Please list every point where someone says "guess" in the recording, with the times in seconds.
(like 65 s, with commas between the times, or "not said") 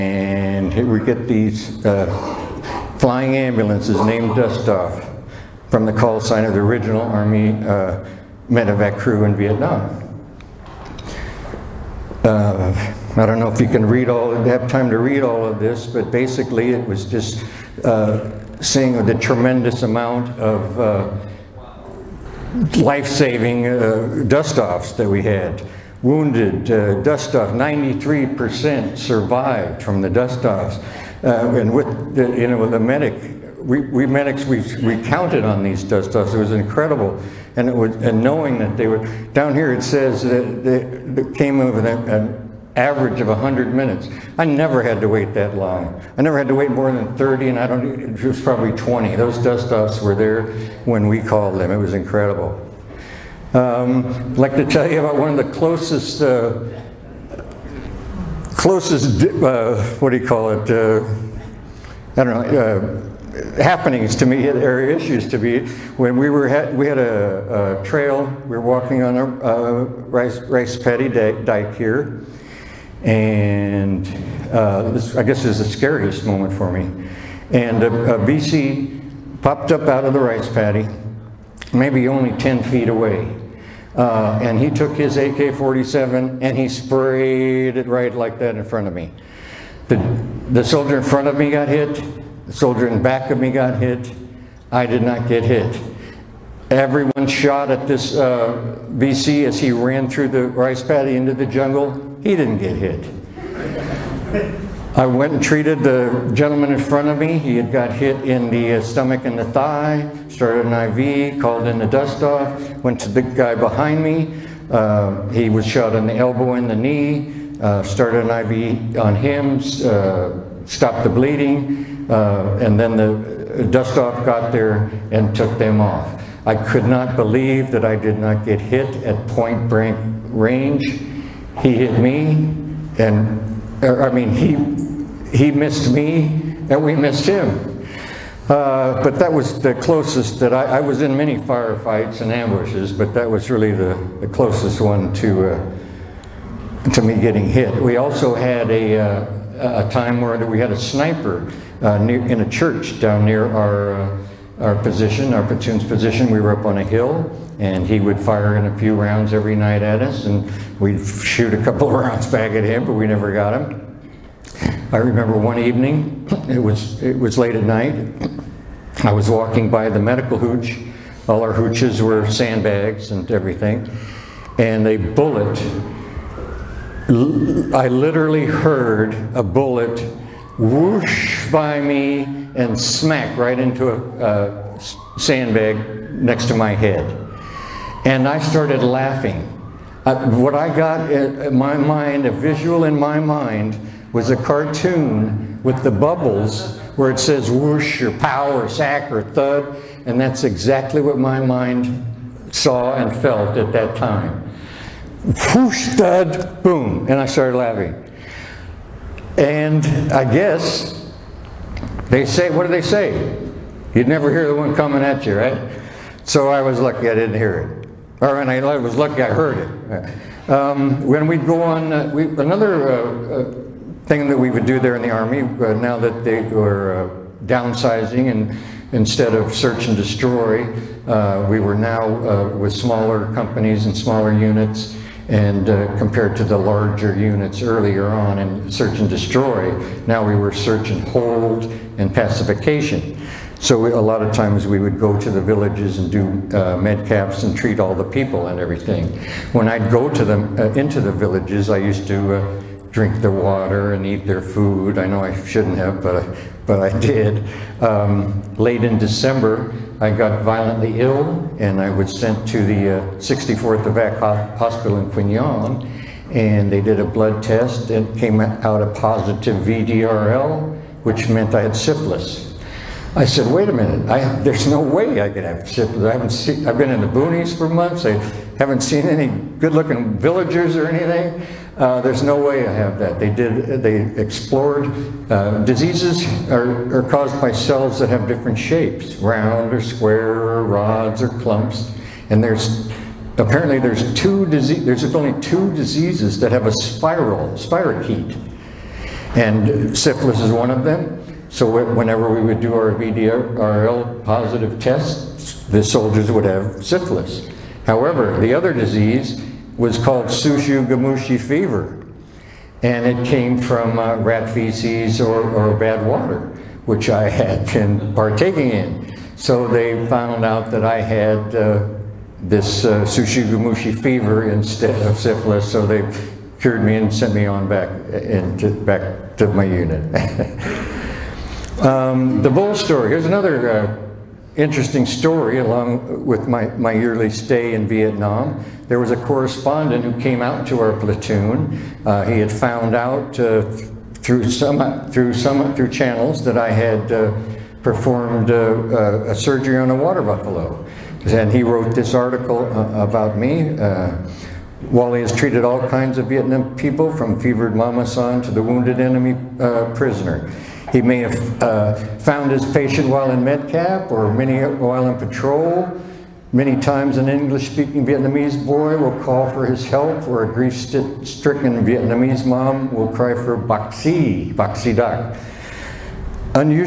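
75 s, 210 s.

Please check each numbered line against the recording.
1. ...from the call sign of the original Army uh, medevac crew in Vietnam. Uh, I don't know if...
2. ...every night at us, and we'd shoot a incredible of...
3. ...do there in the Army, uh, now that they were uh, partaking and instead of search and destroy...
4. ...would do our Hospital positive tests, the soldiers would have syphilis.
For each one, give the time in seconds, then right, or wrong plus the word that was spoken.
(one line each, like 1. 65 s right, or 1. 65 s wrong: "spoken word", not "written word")
1. 5 s right
2. 159 s wrong: "couple", not "incredible"
3. 224 s wrong: "downsizing", not "partaking"
4. 302 s wrong: "VDRL", not "Hospital".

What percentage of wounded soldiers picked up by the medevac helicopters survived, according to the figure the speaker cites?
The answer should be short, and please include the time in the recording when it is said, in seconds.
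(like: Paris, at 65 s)
93%, at 27 s.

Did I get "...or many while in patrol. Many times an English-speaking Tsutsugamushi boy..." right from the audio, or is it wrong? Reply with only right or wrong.
wrong.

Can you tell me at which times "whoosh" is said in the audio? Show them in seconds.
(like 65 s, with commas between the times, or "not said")
180 s, 197 s, 205 s.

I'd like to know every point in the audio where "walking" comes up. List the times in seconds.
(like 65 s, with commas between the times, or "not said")
68 s, 169 s.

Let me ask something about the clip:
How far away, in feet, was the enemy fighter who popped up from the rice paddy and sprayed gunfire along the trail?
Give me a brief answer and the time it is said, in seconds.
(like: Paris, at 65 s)
10 feet, at 82 s.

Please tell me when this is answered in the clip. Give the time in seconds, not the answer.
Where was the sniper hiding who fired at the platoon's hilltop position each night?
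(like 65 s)
152 s.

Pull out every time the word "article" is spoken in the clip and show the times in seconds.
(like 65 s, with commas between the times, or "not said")
352 s.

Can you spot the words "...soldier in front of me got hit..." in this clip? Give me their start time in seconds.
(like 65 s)
90 s.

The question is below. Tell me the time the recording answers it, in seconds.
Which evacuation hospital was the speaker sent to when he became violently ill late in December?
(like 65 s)
263 s.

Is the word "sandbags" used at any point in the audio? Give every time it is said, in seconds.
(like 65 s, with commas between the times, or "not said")
172 s, 185 s.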